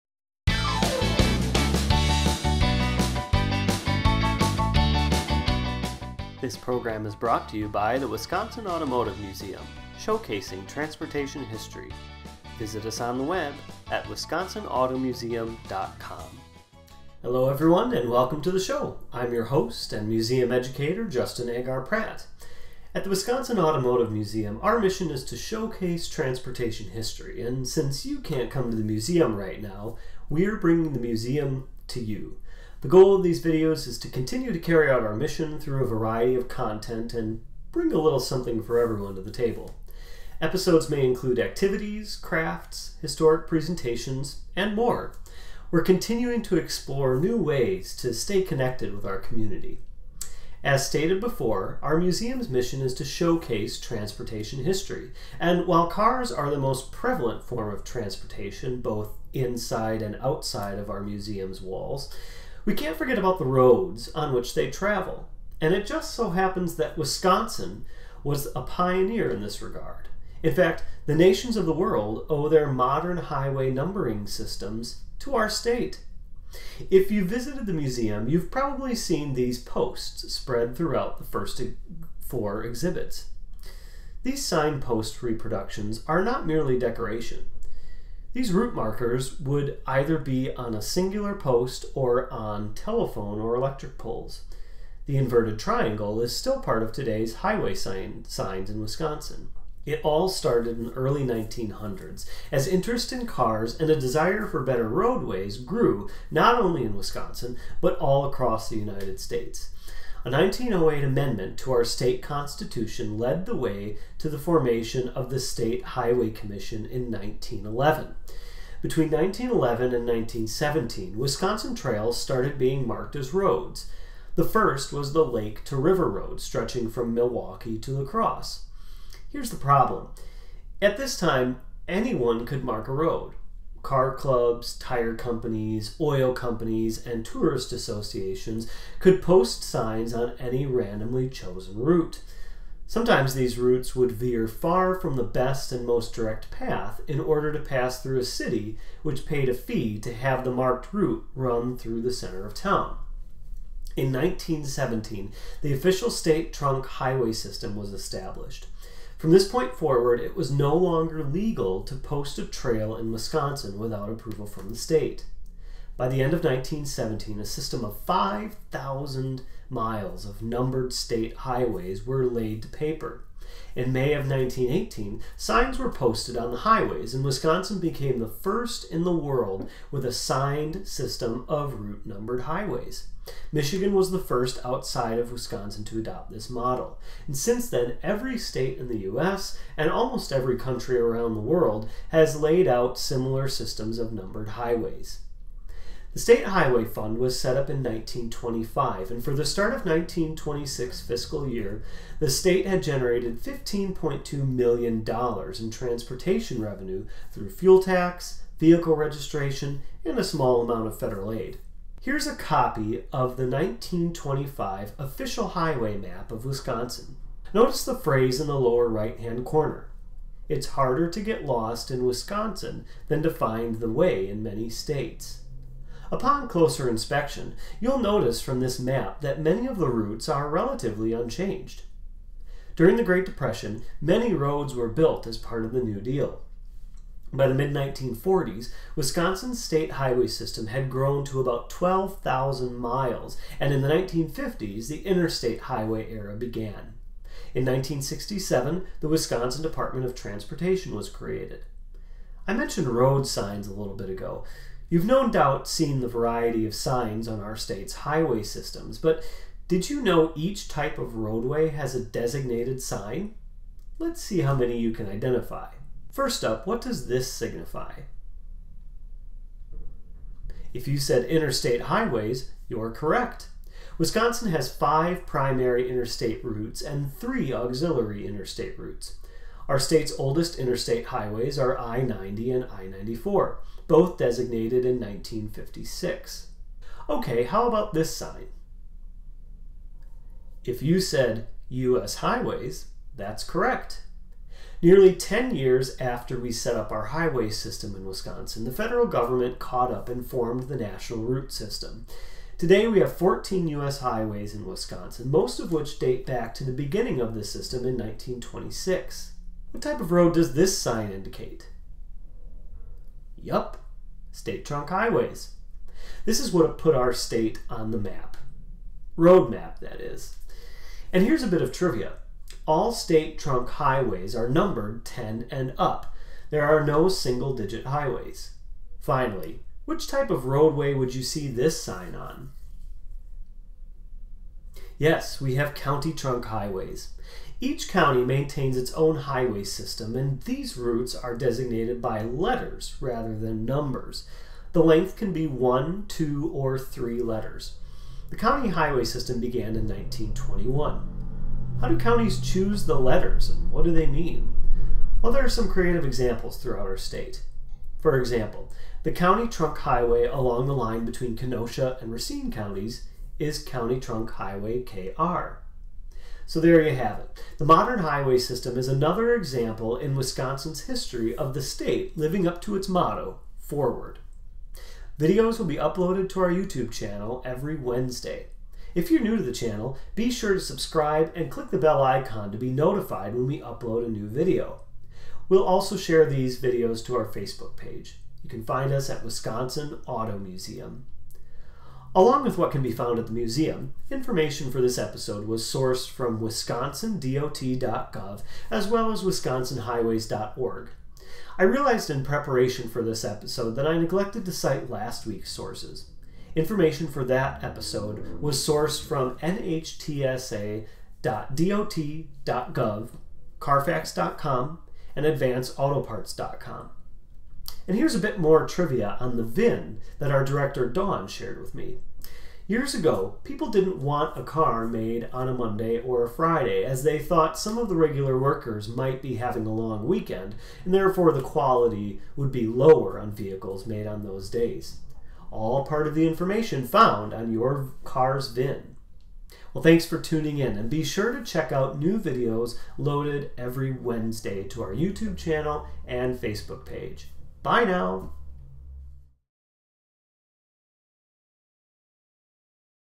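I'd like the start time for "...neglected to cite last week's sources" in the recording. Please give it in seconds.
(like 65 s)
403 s.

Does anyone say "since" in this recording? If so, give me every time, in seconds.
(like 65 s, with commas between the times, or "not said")
27 s, 187 s.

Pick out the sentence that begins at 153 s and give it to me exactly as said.
In 1917, the official state trunk highway system was established.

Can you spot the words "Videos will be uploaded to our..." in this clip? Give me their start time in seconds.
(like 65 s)
375 s.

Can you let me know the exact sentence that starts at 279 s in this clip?
Our state's oldest interstate highways are I 90 and I 94, both designated in 1956.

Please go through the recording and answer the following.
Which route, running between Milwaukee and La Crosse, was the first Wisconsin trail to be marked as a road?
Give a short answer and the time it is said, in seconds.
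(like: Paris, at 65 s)
Lake to River Road, at 125 s.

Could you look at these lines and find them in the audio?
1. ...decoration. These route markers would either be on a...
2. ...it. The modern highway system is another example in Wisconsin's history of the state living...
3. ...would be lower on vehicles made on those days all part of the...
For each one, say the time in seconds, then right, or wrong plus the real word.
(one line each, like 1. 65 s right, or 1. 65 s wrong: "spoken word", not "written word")
1. 86 s right
2. 367 s right
3. 432 s right.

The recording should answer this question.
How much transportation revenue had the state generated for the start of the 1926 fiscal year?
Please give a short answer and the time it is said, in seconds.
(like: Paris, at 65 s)
$15.2 million, at 203 s.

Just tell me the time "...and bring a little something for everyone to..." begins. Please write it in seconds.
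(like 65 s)
37 s.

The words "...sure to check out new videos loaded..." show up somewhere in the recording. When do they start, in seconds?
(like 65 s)
441 s.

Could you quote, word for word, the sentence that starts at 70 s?
In fact, the nations of the world owe their modern highway numbering systems to our state.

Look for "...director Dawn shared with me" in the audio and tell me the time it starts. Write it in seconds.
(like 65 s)
420 s.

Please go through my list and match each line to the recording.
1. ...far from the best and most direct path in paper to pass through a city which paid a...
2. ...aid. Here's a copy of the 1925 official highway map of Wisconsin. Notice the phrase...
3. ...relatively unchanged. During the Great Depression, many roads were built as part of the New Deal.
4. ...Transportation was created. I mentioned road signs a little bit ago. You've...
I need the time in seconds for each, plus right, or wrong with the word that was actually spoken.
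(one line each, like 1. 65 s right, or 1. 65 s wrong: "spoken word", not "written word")
1. 144 s wrong: "order", not "paper"
2. 211 s right
3. 230 s right
4. 250 s right.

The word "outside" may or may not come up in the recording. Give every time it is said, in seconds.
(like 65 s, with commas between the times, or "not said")
60 s, 184 s.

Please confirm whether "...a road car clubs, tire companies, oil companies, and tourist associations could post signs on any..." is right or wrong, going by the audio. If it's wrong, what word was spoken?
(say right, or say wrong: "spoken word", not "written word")
right.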